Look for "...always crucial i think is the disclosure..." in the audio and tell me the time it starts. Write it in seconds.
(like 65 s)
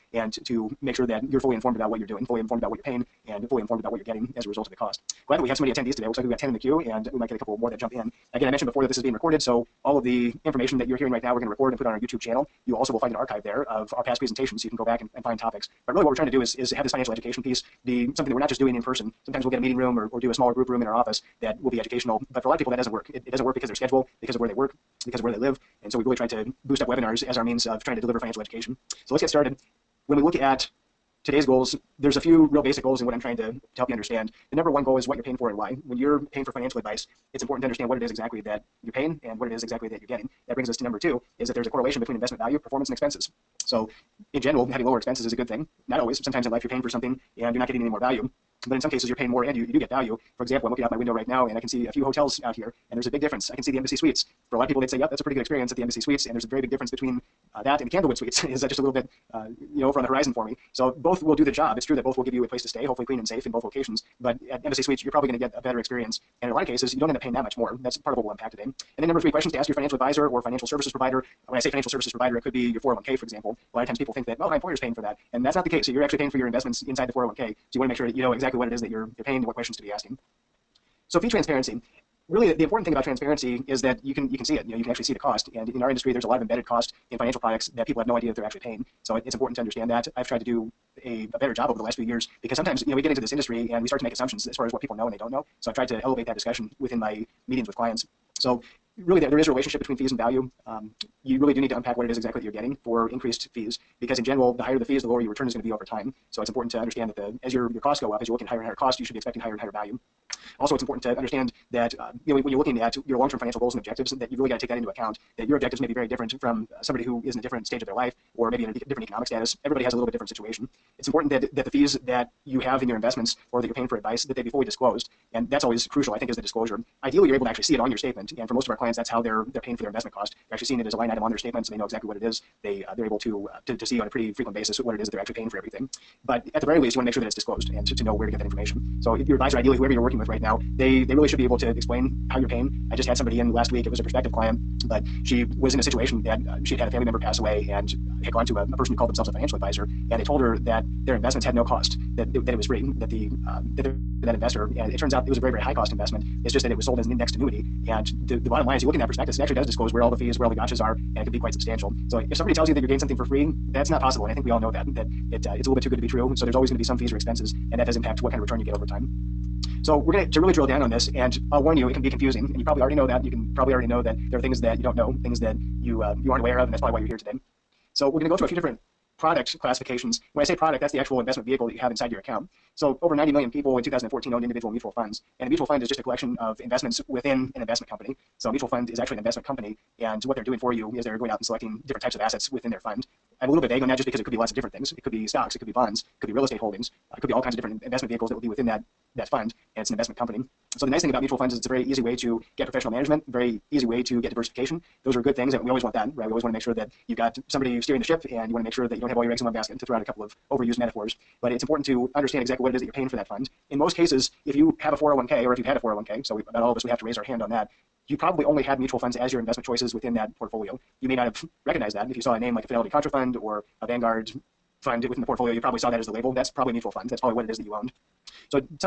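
125 s.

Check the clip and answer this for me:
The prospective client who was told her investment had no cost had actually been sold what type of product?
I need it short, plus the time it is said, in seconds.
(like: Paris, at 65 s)
indexed annuity, at 157 s.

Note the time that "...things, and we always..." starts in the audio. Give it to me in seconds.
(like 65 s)
205 s.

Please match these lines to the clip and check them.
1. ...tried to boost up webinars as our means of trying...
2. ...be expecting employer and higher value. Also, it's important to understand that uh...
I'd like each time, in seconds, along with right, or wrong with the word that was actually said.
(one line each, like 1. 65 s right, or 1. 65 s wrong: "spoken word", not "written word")
1. 26 s right
2. 109 s wrong: "higher", not "employer".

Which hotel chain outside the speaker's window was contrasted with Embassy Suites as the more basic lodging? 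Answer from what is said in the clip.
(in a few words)
Candlewood Suites.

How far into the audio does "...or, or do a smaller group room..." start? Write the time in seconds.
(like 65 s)
19 s.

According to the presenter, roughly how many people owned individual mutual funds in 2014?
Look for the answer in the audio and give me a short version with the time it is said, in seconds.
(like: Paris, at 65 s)
over 90 million, at 183 s.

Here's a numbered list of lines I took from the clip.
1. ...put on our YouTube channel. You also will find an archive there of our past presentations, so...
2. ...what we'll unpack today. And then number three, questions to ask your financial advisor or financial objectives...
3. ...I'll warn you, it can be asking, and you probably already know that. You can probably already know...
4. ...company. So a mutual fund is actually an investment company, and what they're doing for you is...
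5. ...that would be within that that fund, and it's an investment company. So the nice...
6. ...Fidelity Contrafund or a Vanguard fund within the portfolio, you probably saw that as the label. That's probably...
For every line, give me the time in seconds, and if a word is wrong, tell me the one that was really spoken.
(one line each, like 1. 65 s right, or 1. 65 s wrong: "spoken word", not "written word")
1. 11 s right
2. 68 s wrong: "services", not "objectives"
3. 171 s wrong: "confusing", not "asking"
4. 187 s right
5. 198 s right
6. 222 s right.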